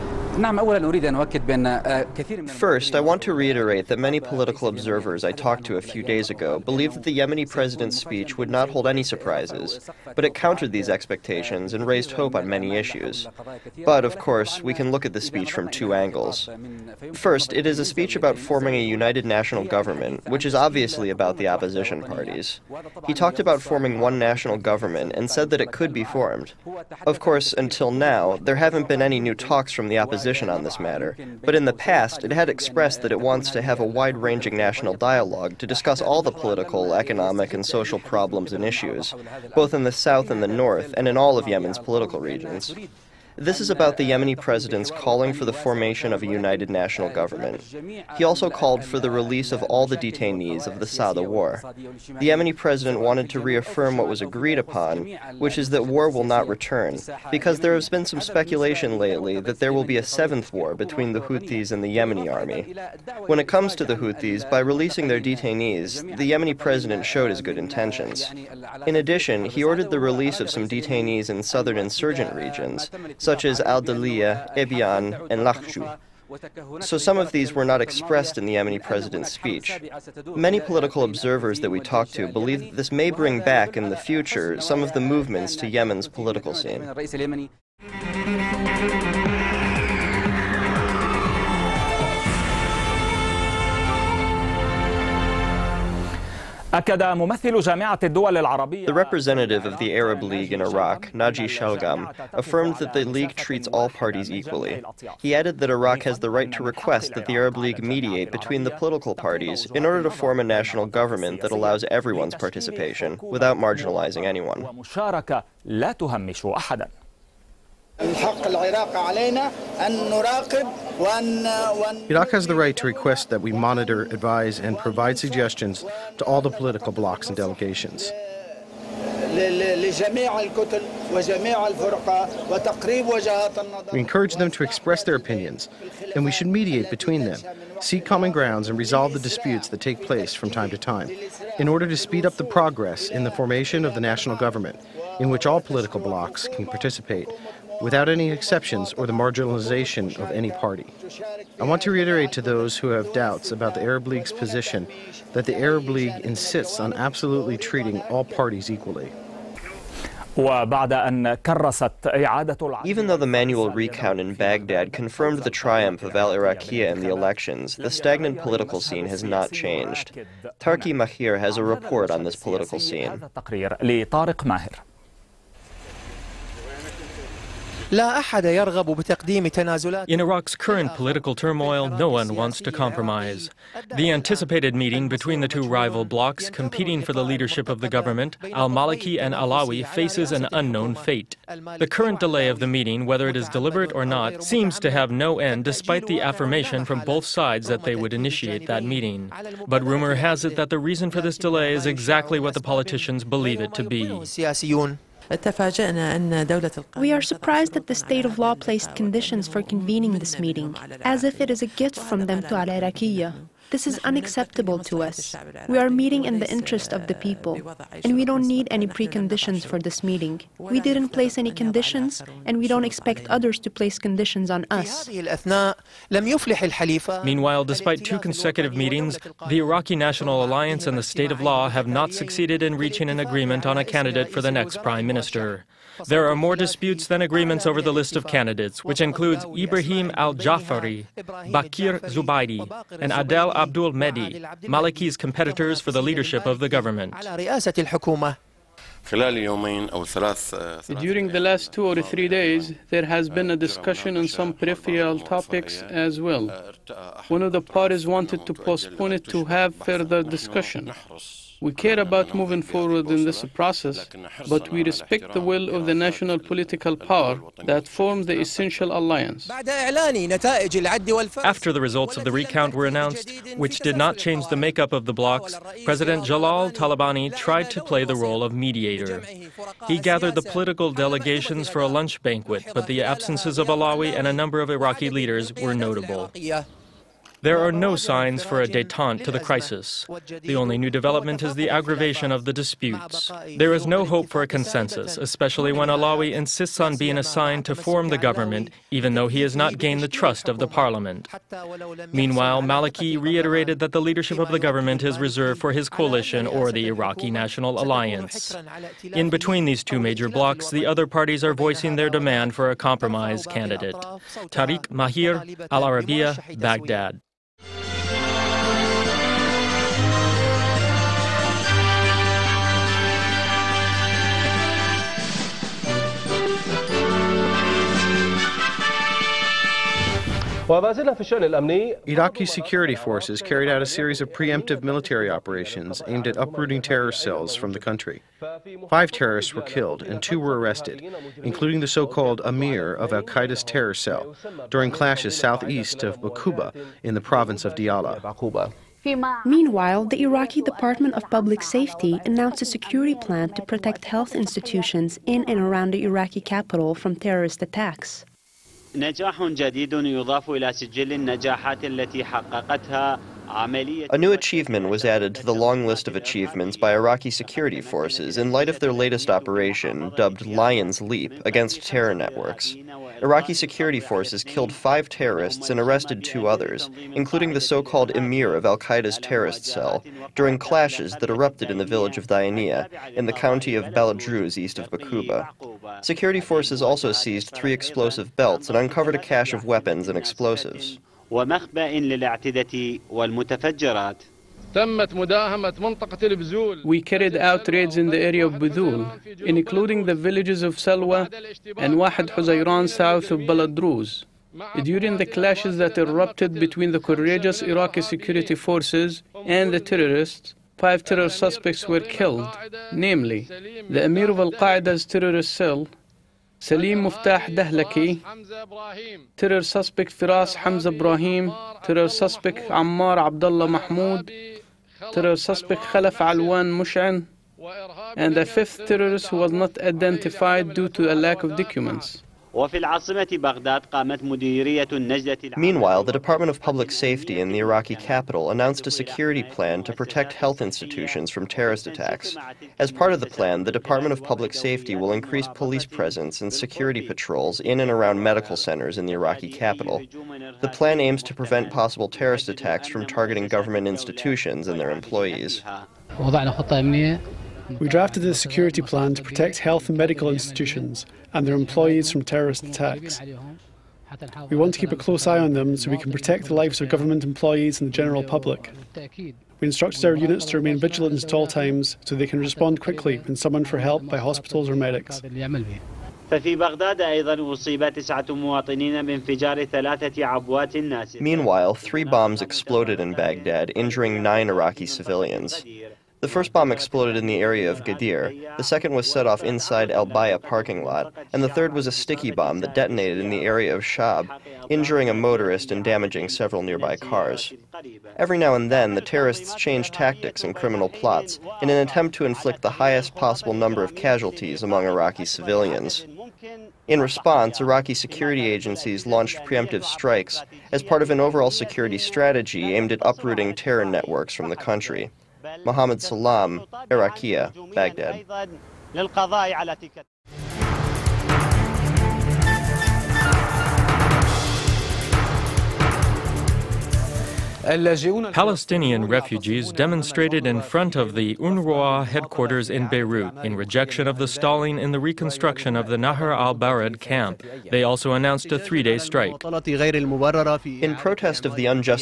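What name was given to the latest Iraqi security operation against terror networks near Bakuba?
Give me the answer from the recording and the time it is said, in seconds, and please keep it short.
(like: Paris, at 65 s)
Lion's Leap, at 370 s.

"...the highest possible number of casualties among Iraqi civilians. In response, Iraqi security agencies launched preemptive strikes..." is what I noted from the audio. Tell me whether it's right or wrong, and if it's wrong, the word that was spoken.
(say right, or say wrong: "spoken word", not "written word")
right.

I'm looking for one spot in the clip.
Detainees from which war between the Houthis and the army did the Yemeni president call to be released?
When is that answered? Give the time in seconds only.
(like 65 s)
50 s.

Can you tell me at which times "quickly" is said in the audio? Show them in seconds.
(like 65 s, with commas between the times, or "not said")
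472 s.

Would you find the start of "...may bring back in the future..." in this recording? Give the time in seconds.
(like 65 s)
82 s.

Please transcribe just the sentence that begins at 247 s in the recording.
During the last two or three days, there has been a discussion on some peripheral topics as well.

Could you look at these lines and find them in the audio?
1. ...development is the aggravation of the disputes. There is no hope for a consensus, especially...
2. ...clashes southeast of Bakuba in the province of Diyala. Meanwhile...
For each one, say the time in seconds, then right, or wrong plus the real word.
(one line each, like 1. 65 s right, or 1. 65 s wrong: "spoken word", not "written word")
1. 290 s right
2. 344 s right.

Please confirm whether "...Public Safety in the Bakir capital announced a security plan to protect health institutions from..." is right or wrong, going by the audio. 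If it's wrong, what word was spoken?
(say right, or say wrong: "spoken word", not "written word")
wrong: "Iraqi", not "Bakir".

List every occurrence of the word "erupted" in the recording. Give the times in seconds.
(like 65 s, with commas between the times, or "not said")
381 s, 405 s.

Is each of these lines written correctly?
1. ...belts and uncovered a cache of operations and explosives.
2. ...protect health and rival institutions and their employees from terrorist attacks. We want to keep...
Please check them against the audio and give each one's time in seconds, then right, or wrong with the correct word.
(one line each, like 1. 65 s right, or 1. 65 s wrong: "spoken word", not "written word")
1. 388 s wrong: "weapons", not "operations"
2. 459 s wrong: "medical", not "rival".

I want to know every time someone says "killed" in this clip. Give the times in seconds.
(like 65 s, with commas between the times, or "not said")
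339 s, 374 s, 411 s.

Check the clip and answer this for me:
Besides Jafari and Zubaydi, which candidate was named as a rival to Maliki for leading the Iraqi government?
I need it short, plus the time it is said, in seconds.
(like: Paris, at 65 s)
Adel Abdul Mehdi, at 243 s.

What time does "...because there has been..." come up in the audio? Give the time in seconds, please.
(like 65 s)
57 s.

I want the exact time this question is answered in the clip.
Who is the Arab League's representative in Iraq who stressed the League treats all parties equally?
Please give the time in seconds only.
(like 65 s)
101 s.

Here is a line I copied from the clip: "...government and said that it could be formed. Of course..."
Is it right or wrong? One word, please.
right.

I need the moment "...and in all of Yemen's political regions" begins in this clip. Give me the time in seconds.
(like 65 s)
40 s.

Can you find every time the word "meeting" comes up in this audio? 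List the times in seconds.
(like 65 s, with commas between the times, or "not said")
184 s, 192 s, 198 s, 210 s, 215 s, 220 s, 228 s.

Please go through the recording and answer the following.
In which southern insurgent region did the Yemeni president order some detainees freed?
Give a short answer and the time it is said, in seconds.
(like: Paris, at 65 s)
Al-Daliya, at 73 s.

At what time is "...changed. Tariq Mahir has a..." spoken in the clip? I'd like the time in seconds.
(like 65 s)
169 s.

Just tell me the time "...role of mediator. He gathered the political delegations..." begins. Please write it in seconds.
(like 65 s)
278 s.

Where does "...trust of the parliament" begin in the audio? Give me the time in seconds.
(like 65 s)
300 s.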